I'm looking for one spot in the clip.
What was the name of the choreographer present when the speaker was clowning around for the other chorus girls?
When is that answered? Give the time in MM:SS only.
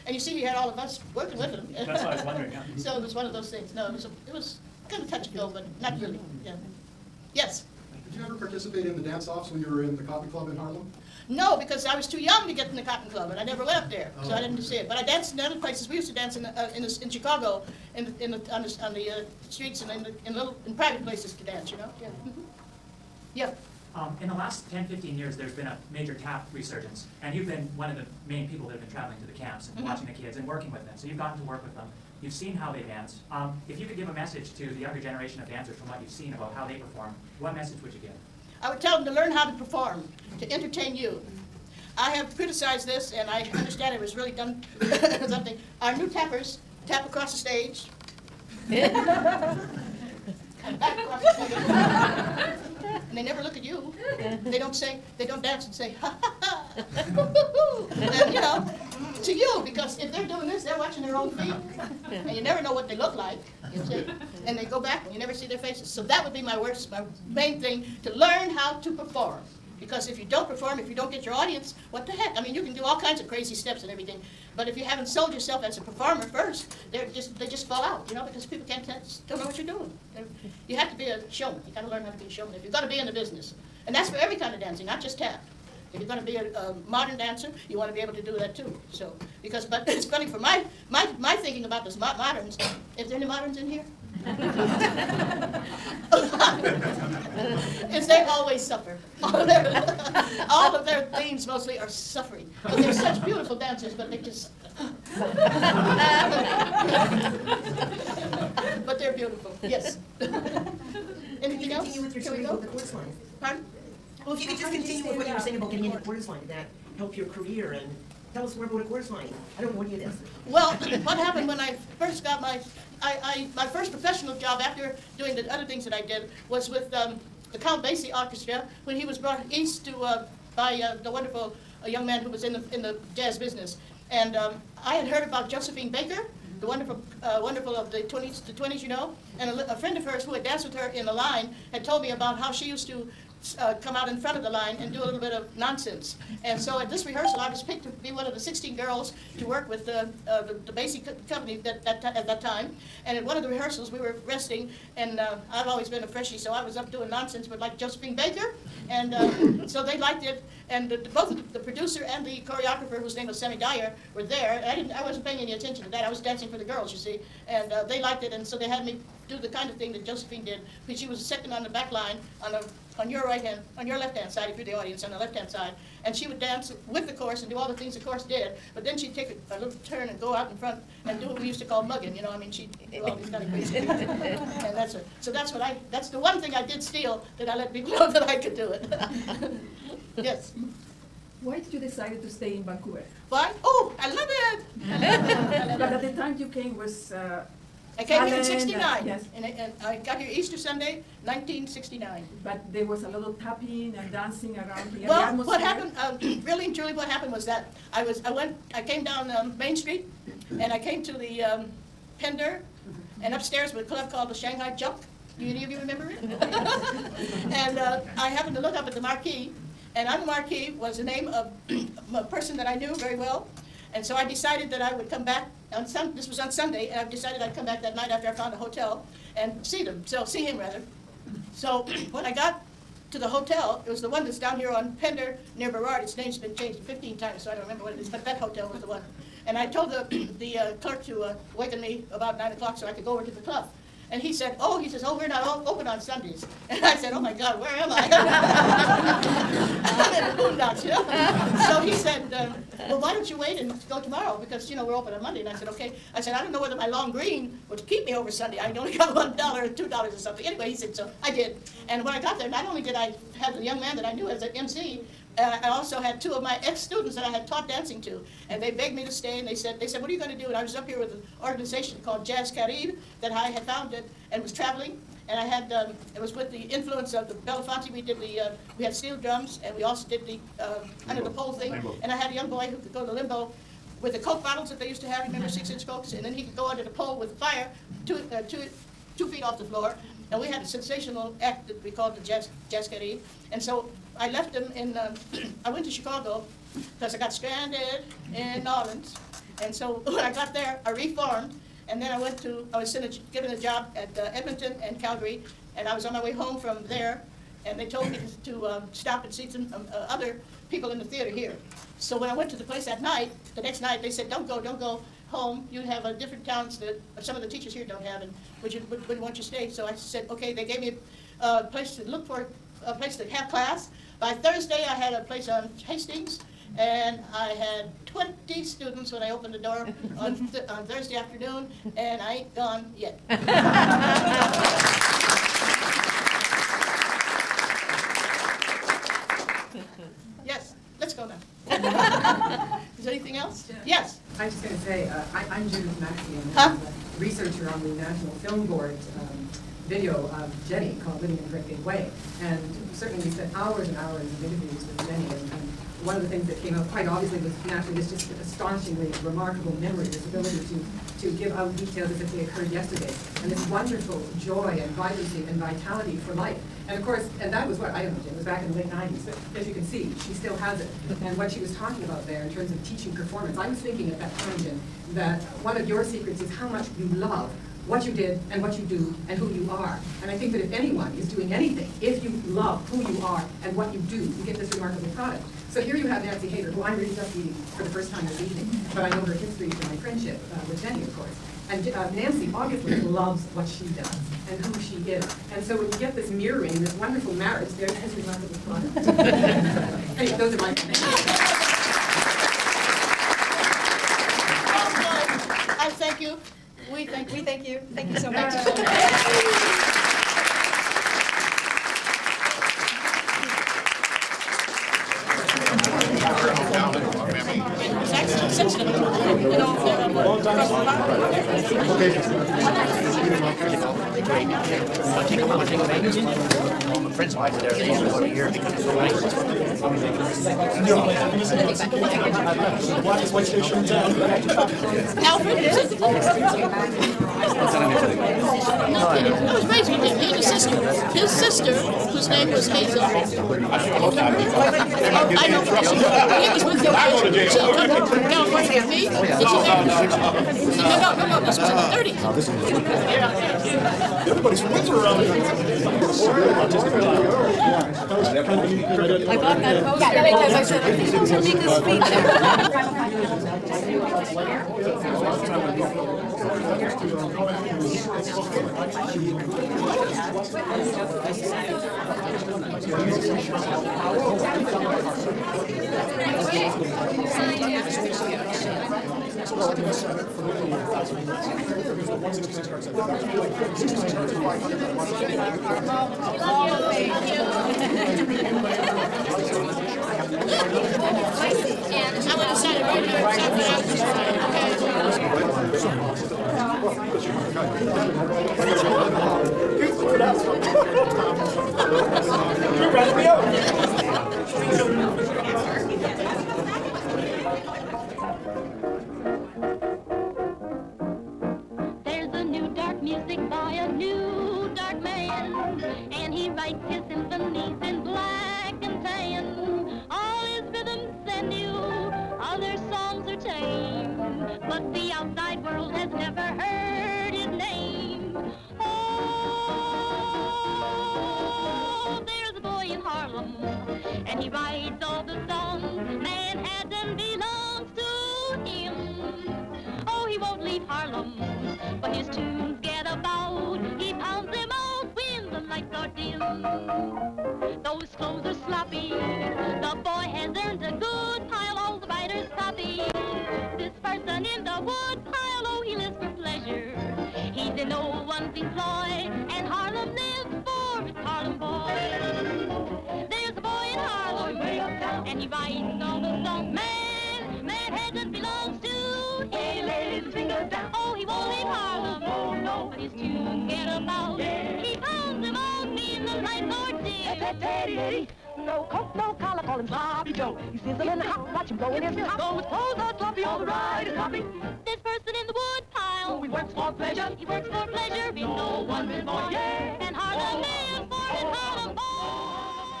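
02:43.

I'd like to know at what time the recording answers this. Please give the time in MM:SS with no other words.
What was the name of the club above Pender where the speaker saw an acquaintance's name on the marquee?
03:34.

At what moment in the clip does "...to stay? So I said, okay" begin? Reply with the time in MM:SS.
05:19.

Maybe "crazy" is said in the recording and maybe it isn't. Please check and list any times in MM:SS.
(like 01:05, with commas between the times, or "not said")
01:13, 03:03.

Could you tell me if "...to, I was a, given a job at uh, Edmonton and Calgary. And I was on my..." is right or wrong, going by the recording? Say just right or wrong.
right.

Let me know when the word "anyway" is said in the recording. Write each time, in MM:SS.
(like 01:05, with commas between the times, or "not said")
04:20, 06:40.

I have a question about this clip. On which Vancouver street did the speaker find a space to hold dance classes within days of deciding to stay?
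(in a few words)
Hastings.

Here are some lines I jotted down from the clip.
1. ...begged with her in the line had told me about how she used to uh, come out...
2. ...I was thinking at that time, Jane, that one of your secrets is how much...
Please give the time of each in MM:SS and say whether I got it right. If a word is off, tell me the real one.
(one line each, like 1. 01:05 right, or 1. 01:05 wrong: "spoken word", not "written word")
1. 02:20 wrong: "danced", not "begged"
2. 06:13 right.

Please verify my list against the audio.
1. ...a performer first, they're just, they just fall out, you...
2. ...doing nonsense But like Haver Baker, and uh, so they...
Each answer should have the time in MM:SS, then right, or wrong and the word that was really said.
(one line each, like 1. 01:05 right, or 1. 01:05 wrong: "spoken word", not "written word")
1. 01:15 right
2. 02:36 wrong: "Josephine", not "Haver".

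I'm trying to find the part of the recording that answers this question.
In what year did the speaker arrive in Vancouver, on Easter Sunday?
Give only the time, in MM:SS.
03:21.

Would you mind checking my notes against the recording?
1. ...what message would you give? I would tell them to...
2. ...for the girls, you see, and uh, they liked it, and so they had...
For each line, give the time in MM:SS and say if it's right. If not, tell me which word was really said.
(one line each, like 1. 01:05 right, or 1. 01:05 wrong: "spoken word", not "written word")
1. 00:37 right
2. 02:46 right.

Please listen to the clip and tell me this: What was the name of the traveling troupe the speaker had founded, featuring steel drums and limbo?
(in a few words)
Jazz Carib.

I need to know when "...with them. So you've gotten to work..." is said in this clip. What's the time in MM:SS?
00:30.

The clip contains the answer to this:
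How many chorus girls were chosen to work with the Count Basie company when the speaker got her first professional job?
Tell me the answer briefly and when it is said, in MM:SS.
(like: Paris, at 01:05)
16, at 02:28.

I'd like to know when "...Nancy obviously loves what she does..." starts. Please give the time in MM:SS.
06:32.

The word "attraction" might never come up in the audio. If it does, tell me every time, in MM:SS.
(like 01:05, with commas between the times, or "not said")
not said.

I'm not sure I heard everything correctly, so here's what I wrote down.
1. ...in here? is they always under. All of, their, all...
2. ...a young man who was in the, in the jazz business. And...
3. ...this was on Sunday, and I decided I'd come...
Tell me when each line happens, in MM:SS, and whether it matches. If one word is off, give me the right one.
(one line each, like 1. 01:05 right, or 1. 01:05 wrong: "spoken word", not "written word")
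1. 01:33 wrong: "suffer", not "under"
2. 02:11 right
3. 03:46 right.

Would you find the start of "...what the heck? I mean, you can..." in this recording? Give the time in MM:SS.
01:11.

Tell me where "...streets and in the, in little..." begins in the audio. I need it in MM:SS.
00:19.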